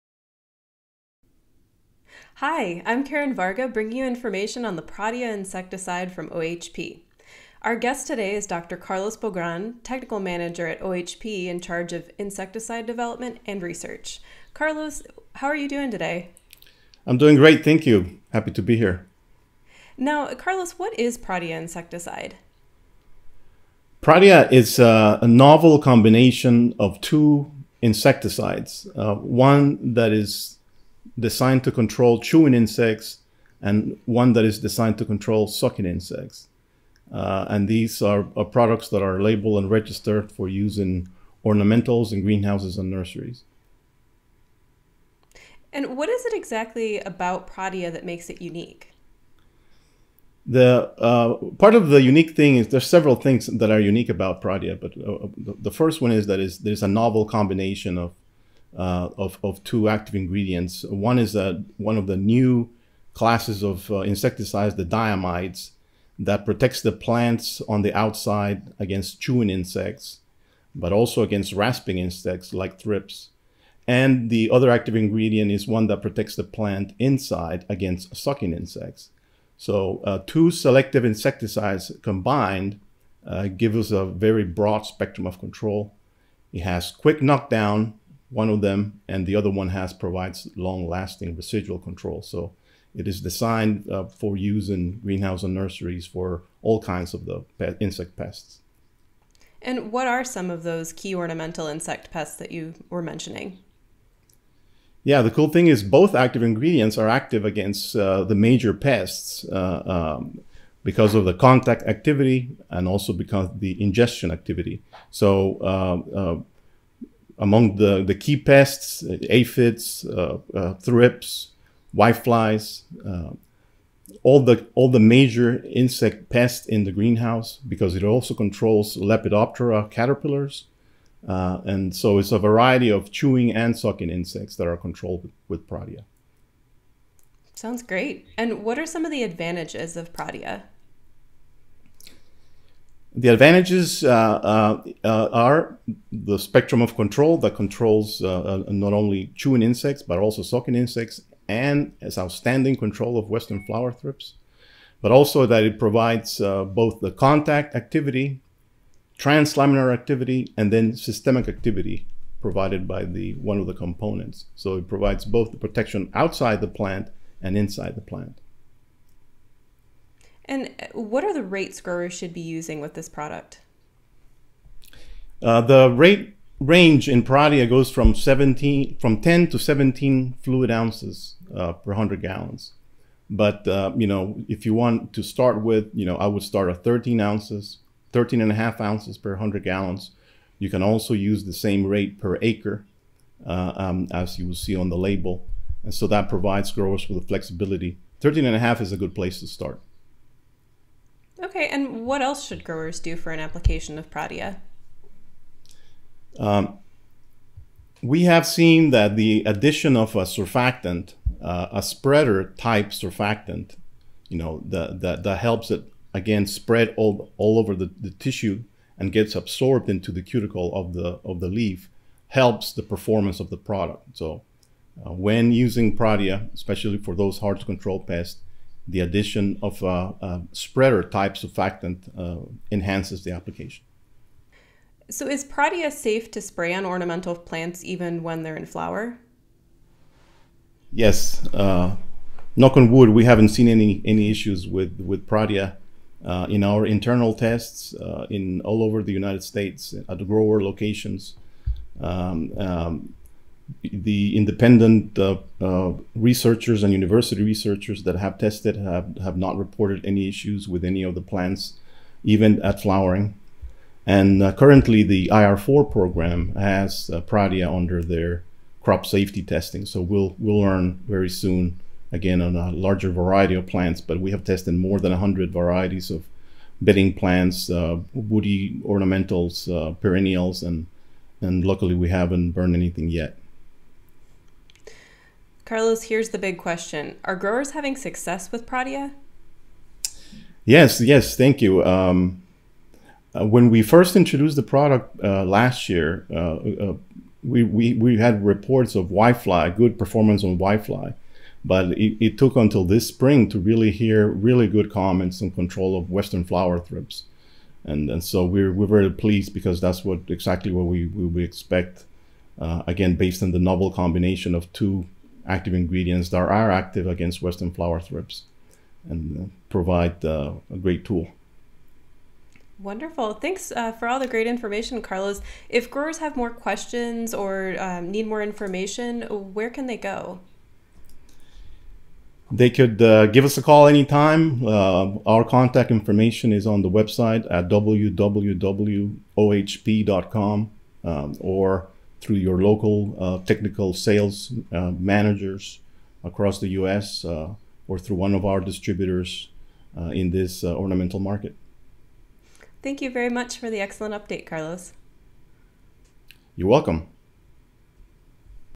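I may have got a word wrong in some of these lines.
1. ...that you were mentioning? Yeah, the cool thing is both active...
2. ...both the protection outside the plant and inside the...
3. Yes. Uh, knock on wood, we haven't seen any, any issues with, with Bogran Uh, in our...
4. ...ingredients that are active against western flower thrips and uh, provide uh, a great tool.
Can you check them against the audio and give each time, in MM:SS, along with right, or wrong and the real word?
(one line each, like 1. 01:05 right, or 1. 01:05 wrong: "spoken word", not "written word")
1. 01:42 right
2. 02:45 right
3. 04:00 wrong: "Pradia", not "Bogran"
4. 05:15 right.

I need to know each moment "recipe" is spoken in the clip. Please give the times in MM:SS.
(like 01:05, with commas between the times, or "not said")
not said.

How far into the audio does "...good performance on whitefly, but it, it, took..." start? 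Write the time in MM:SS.
04:59.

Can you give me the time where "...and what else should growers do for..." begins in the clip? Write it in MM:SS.
03:21.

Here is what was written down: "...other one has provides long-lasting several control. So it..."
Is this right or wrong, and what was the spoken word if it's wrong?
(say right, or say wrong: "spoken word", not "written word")
wrong: "residual", not "several".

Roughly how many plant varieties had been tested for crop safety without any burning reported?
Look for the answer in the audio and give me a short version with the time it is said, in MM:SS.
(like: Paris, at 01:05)
more than 100, at 04:34.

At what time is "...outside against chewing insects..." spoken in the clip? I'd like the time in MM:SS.
01:07.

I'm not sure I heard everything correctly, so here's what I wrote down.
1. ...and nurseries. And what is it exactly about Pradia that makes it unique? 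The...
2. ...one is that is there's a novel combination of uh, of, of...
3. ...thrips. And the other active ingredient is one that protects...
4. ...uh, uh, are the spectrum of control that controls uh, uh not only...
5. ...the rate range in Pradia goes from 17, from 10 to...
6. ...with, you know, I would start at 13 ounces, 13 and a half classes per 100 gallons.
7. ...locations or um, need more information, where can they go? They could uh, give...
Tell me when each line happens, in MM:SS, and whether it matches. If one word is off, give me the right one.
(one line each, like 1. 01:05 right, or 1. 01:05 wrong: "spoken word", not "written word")
1. 00:42 right
2. 00:56 right
3. 01:12 right
4. 02:24 right
5. 02:55 right
6. 03:05 wrong: "ounces", not "classes"
7. 05:26 wrong: "questions", not "locations".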